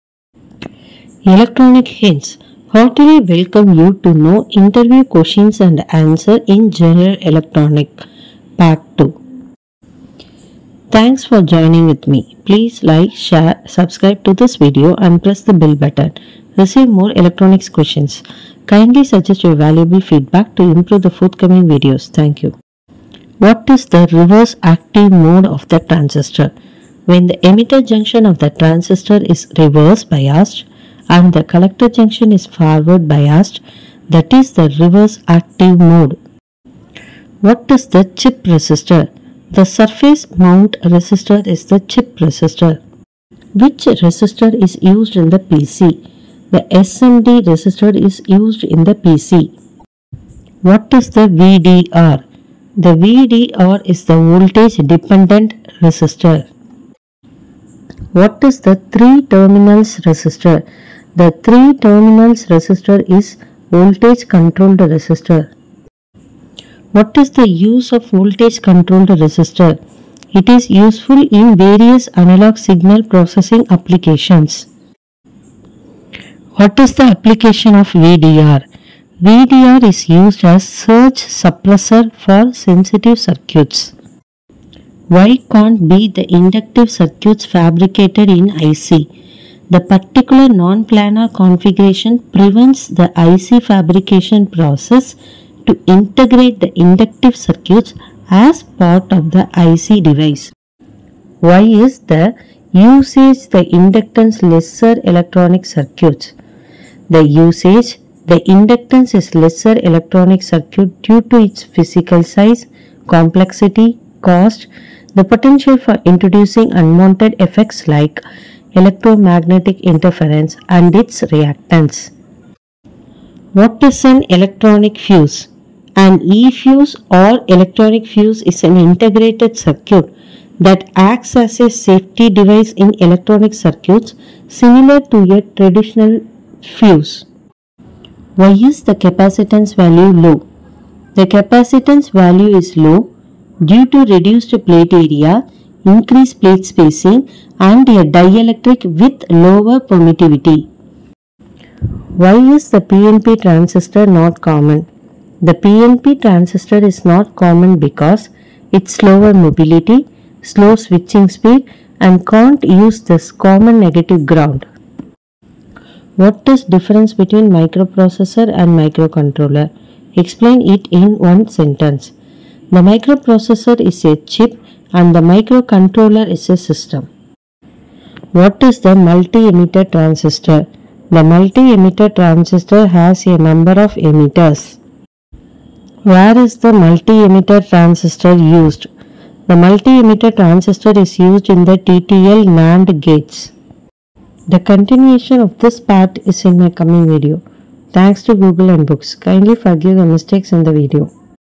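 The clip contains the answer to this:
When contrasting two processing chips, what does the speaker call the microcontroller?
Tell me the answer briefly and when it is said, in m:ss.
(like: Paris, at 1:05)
a system, at 2:56.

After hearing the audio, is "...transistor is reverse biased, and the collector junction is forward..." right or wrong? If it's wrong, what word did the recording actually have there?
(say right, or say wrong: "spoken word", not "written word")
right.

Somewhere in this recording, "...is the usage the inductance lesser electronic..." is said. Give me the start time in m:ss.
1:41.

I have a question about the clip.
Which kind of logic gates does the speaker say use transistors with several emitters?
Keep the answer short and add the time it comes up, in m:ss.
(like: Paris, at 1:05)
TTL NAND gates, at 3:11.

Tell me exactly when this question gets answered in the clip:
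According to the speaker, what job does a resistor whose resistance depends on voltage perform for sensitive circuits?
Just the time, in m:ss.
1:20.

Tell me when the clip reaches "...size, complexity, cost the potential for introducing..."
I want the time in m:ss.
1:52.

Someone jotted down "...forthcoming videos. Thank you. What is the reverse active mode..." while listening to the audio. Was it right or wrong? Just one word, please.
right.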